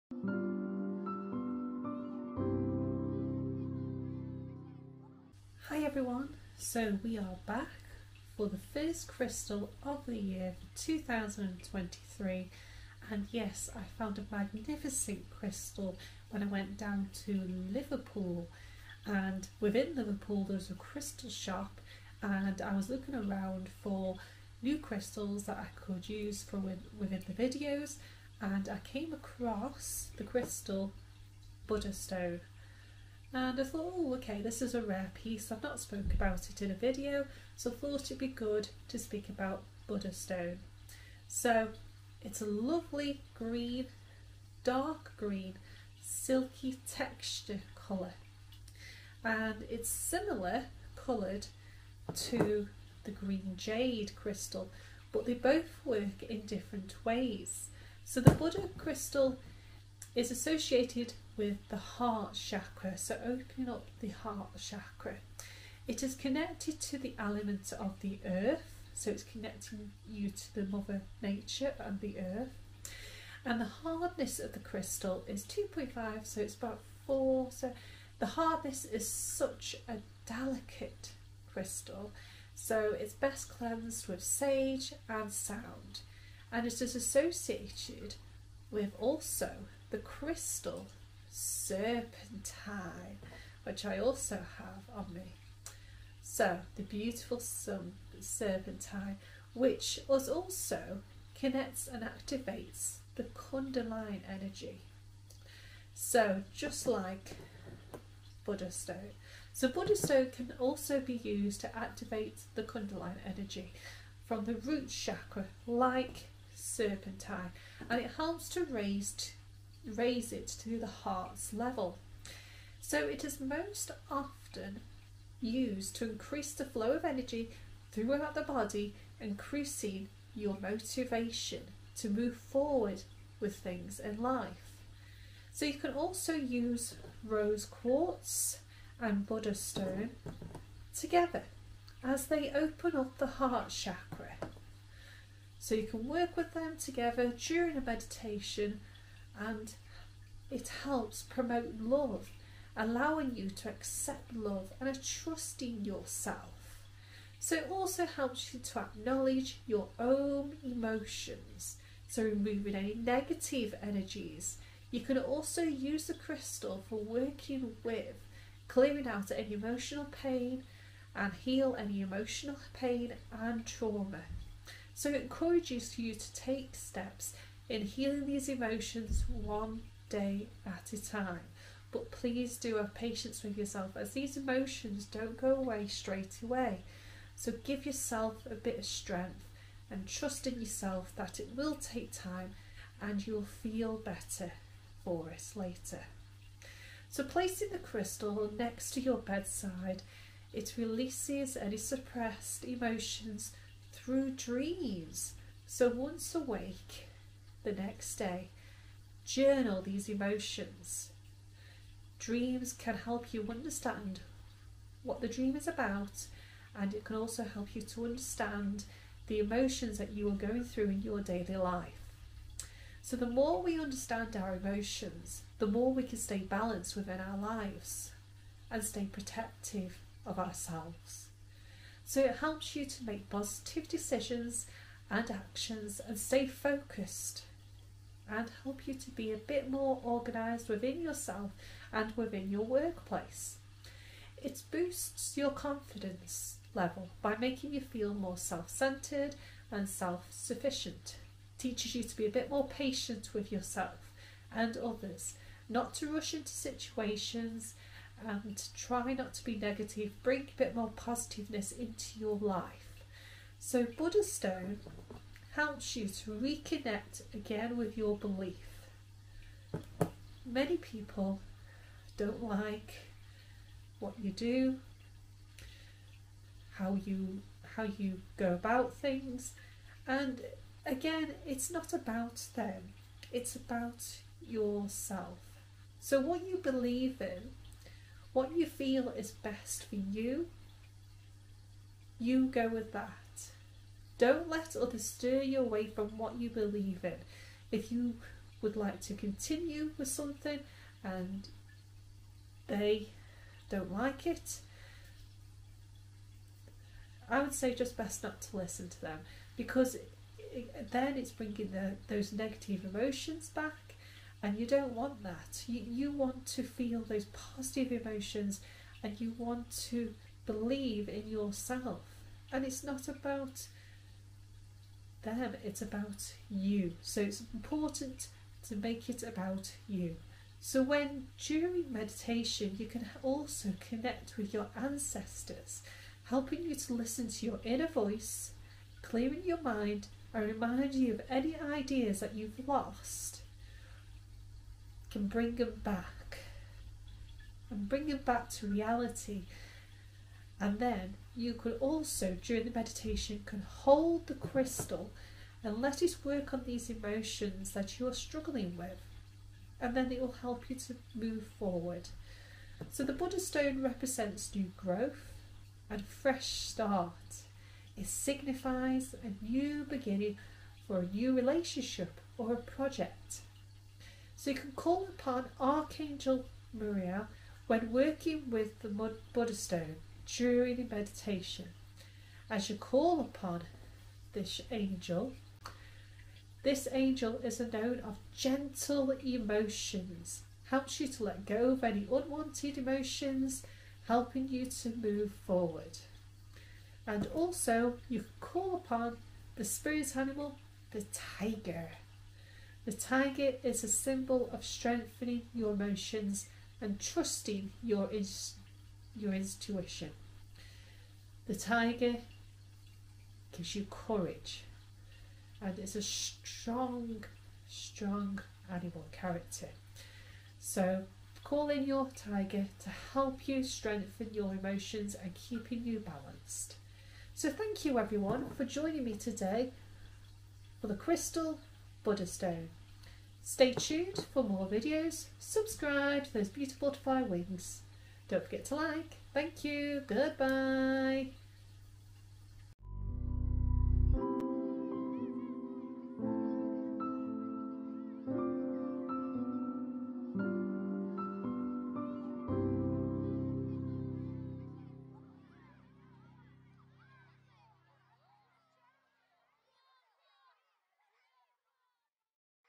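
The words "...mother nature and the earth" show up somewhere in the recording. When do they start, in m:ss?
1:10.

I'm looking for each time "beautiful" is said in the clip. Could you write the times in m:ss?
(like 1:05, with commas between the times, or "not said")
1:36, 7:16.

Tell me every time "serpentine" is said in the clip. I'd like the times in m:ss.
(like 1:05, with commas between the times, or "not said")
1:31, 1:38, 1:56.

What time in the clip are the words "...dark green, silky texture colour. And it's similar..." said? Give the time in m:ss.
0:44.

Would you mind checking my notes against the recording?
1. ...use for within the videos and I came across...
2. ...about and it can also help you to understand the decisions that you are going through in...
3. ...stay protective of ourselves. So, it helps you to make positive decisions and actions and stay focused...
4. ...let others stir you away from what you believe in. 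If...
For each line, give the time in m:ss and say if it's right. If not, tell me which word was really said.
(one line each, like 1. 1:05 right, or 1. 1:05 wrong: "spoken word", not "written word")
1. 0:26 right
2. 3:35 wrong: "emotions", not "decisions"
3. 3:48 right
4. 4:54 right.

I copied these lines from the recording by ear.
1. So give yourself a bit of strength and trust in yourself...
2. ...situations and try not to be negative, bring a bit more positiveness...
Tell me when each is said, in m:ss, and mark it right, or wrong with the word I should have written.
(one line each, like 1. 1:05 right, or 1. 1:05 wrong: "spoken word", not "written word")
1. 3:07 right
2. 4:16 right.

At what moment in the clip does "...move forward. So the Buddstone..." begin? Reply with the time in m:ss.
6:01.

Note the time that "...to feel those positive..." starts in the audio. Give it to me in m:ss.
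5:16.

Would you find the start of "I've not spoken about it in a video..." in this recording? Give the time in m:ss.
0:35.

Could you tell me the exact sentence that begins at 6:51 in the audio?
The tiger gives you courage and it's a strong, strong animal character.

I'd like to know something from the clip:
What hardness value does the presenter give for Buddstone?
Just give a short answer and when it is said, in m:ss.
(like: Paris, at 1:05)
2.5, at 1:15.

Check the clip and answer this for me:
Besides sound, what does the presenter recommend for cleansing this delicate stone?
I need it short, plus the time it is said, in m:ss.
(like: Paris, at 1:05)
sage, at 1:24.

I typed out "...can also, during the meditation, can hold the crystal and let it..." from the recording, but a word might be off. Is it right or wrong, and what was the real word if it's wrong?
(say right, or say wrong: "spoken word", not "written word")
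right.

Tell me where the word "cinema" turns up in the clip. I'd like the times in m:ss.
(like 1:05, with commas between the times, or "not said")
not said.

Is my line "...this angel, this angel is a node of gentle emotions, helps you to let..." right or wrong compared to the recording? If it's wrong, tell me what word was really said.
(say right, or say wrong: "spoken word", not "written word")
right.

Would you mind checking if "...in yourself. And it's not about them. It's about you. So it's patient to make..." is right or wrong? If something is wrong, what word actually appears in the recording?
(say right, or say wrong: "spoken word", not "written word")
wrong: "important", not "patient".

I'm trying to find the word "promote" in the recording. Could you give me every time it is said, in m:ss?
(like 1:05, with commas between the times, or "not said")
2:31.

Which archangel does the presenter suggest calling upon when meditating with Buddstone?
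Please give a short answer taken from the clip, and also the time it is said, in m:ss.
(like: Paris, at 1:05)
Archangel Muriel, at 6:15.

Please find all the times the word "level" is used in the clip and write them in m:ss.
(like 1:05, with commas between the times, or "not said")
2:01, 4:06.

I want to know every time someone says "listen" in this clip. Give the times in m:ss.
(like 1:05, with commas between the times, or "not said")
5:08, 5:36.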